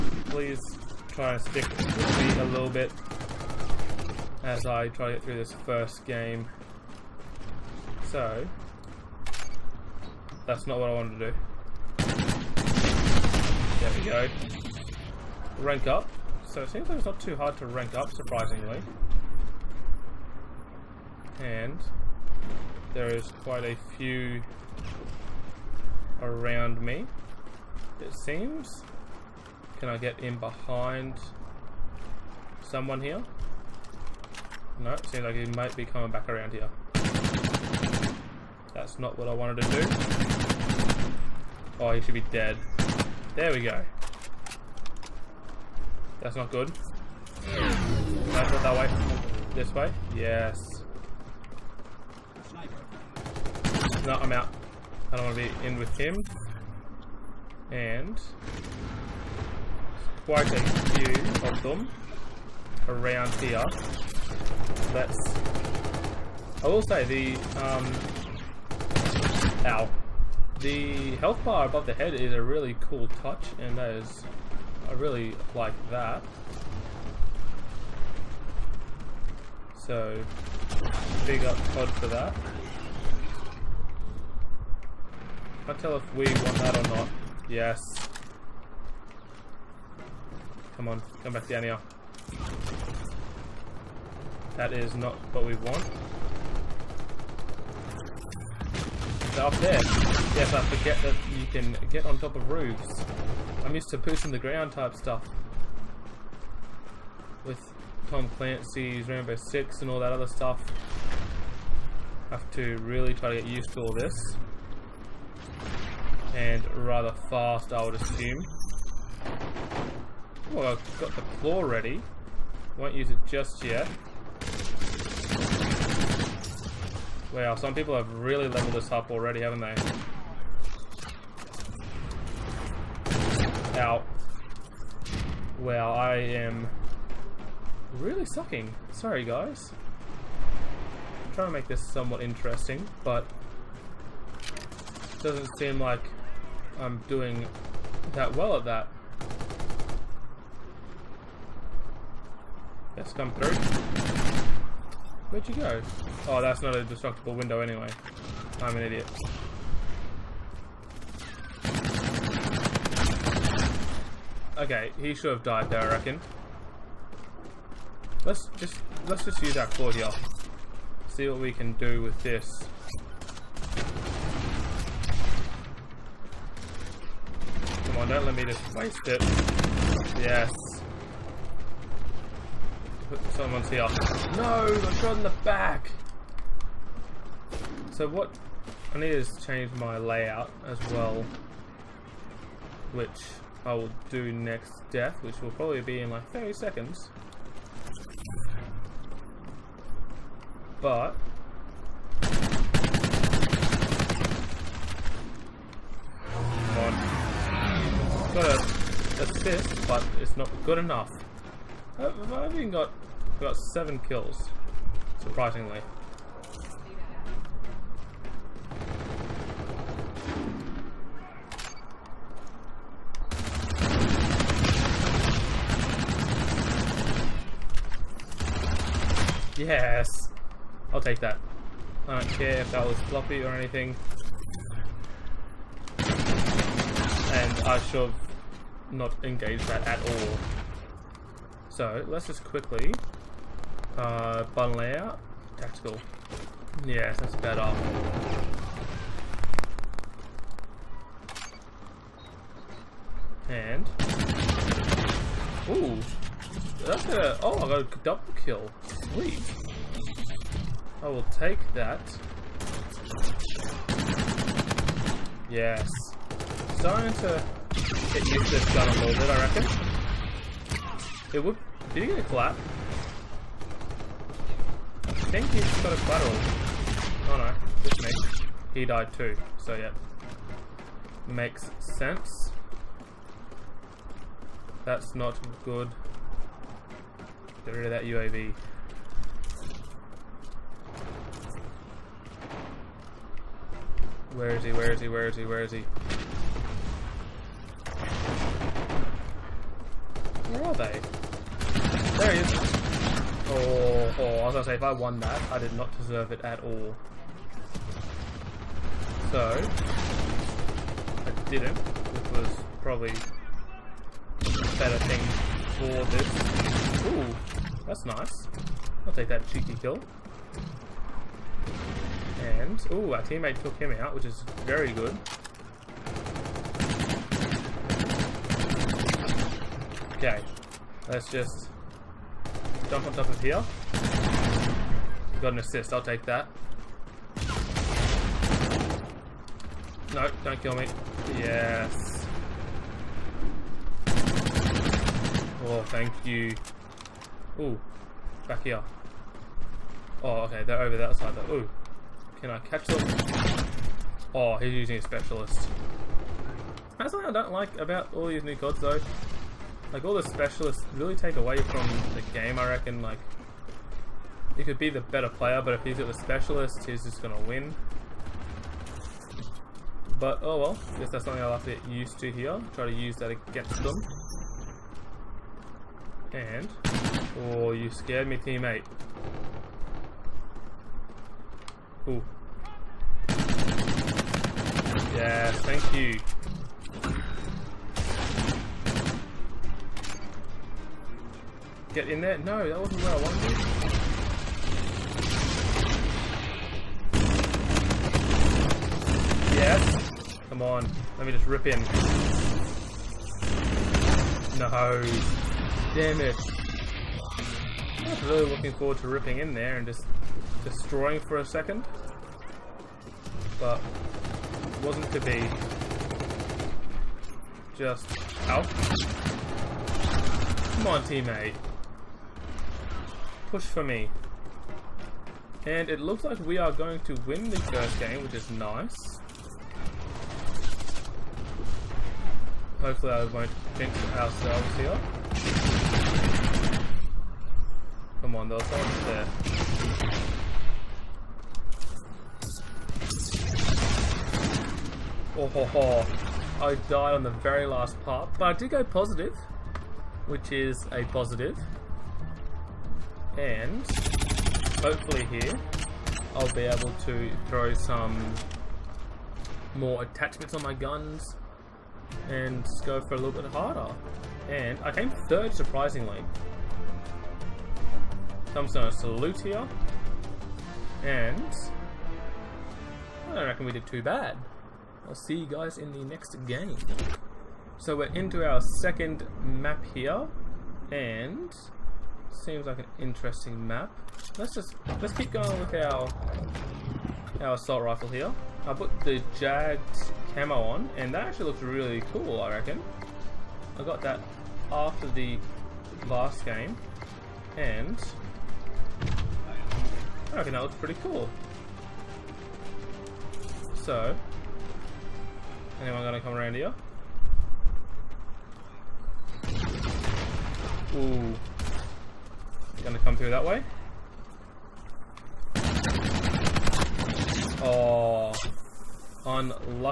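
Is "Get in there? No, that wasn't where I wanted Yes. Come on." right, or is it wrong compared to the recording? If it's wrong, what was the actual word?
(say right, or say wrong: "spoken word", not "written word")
right.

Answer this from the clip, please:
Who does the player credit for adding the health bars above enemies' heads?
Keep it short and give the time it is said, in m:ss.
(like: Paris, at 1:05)
Todd, at 1:21.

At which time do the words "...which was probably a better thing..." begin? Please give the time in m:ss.
5:11.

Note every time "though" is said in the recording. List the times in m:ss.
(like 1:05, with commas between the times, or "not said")
5:51, 5:58.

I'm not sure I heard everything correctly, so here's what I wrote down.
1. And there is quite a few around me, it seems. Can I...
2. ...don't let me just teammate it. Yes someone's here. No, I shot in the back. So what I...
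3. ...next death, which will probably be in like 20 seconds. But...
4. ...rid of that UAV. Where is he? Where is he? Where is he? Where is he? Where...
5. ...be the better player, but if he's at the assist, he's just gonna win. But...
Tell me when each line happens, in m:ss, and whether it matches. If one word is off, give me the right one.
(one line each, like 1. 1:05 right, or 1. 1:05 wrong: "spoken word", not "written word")
1. 0:21 right
2. 2:58 wrong: "waste", not "teammate"
3. 3:14 wrong: "30", not "20"
4. 4:47 right
5. 6:04 wrong: "specialist", not "assist".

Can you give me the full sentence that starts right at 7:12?
Hopefully I won't jinx ourselves here.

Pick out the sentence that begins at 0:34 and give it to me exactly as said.
No, it seems like he might be coming back around here.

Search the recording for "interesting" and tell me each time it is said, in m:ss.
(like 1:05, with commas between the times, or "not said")
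2:22, 8:02.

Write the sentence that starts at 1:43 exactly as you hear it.
I'm used to pushing in the ground type stuff.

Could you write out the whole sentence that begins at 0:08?
So, that's not what I wanted to do.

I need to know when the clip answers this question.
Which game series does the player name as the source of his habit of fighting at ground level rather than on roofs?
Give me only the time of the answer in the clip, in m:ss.
1:48.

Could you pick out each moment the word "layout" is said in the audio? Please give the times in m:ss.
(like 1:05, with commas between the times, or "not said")
3:09, 4:04.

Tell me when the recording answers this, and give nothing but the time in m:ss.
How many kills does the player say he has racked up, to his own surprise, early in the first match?
3:33.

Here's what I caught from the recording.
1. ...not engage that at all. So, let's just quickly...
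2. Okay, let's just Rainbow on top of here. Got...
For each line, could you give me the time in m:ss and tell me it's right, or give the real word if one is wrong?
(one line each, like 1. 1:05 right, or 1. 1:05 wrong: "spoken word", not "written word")
1. 3:58 right
2. 5:30 wrong: "Jump", not "Rainbow".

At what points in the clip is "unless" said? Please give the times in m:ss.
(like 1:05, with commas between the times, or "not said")
not said.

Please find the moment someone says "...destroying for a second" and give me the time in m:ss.
6:50.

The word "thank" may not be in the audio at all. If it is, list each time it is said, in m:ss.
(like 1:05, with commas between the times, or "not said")
5:45, 6:25.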